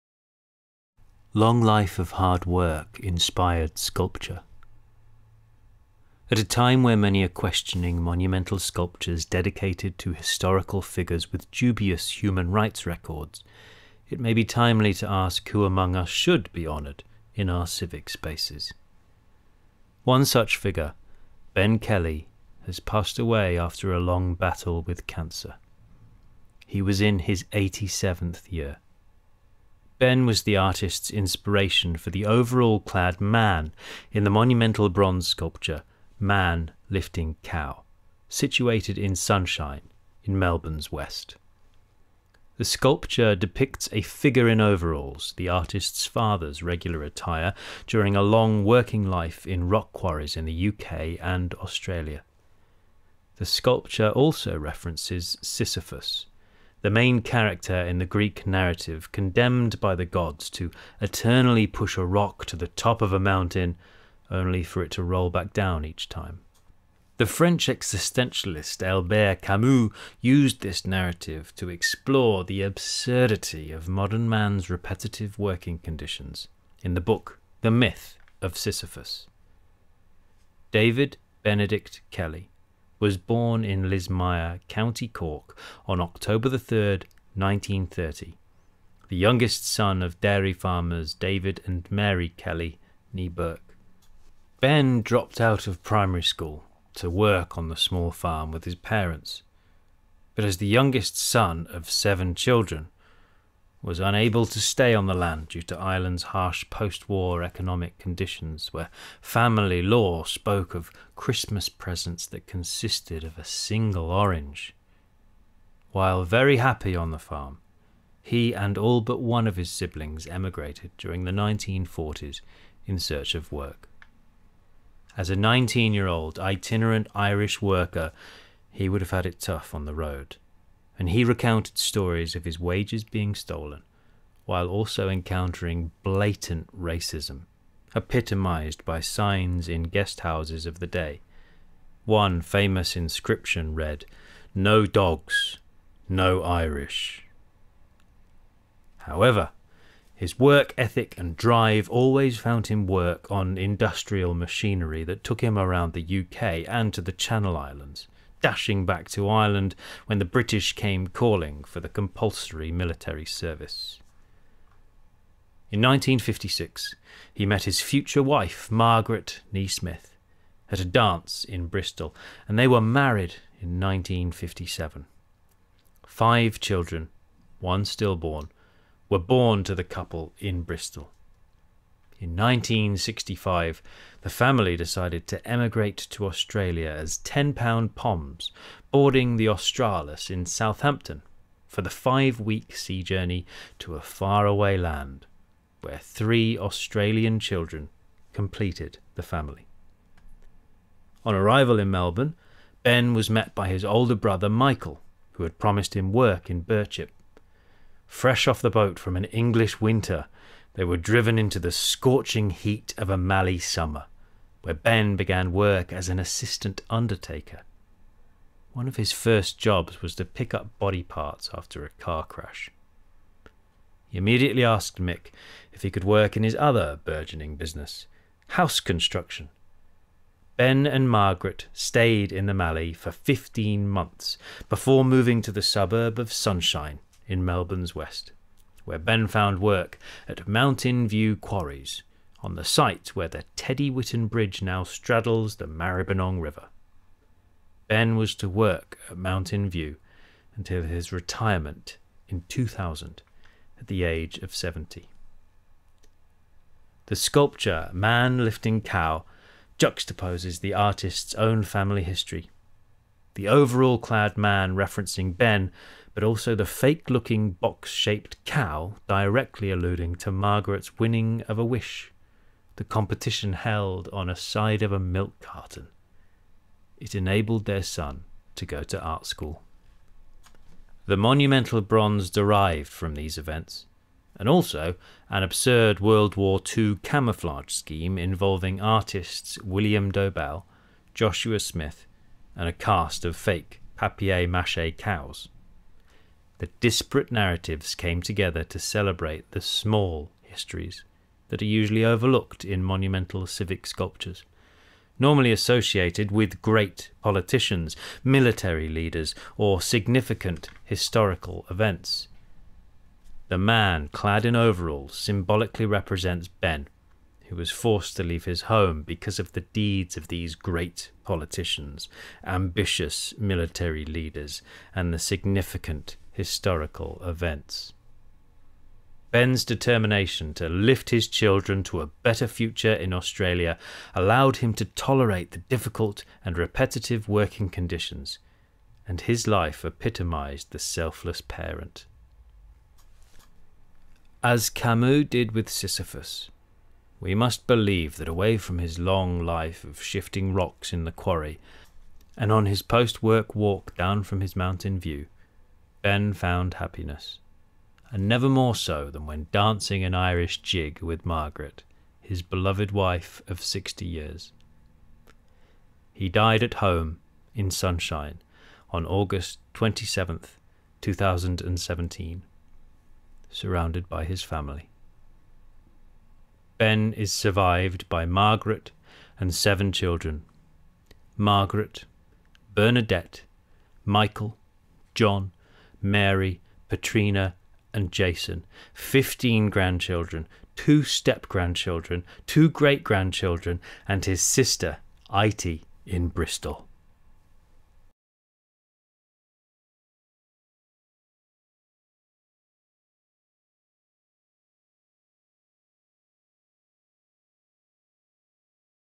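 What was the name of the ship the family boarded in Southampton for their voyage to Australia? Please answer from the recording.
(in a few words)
Australis.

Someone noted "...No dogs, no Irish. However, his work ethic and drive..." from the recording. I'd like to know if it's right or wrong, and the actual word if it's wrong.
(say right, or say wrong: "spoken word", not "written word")
right.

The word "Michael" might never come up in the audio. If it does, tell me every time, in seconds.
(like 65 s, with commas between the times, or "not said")
204 s, 384 s.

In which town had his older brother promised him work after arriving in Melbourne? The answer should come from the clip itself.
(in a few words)
Birchip.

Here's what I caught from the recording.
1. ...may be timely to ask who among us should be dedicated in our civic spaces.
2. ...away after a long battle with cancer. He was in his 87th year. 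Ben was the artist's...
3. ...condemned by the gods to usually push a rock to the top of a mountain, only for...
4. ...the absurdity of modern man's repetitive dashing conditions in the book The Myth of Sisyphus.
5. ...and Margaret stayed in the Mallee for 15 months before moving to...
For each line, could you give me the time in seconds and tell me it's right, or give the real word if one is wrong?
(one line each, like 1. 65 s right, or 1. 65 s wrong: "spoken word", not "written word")
1. 14 s wrong: "honoured", not "dedicated"
2. 23 s right
3. 59 s wrong: "eternally", not "usually"
4. 72 s wrong: "working", not "dashing"
5. 230 s right.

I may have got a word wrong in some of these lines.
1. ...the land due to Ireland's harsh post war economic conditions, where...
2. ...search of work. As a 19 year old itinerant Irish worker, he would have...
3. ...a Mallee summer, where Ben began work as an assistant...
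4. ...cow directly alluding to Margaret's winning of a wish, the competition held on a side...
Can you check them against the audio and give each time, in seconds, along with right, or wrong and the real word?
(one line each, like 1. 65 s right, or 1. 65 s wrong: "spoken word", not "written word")
1. 105 s right
2. 122 s right
3. 213 s right
4. 268 s right.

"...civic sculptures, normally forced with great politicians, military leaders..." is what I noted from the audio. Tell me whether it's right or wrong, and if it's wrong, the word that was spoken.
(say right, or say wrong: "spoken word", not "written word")
wrong: "associated", not "forced".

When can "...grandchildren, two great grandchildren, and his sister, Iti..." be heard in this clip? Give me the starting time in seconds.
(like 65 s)
391 s.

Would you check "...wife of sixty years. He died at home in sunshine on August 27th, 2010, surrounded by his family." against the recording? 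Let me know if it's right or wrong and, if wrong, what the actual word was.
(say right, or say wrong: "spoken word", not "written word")
wrong: "2017", not "2010".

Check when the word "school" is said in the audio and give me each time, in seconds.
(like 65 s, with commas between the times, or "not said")
96 s, 279 s.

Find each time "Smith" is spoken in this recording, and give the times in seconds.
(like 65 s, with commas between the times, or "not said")
169 s, 291 s.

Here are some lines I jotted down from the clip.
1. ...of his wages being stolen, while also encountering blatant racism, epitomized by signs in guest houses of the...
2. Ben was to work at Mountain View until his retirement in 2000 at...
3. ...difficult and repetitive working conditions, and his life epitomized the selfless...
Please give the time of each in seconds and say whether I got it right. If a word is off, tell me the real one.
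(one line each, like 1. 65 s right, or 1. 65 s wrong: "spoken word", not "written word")
1. 132 s right
2. 247 s right
3. 335 s right.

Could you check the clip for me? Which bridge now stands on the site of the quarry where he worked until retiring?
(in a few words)
Teddy Whitten Bridge.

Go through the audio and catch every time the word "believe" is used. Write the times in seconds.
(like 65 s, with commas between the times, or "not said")
347 s.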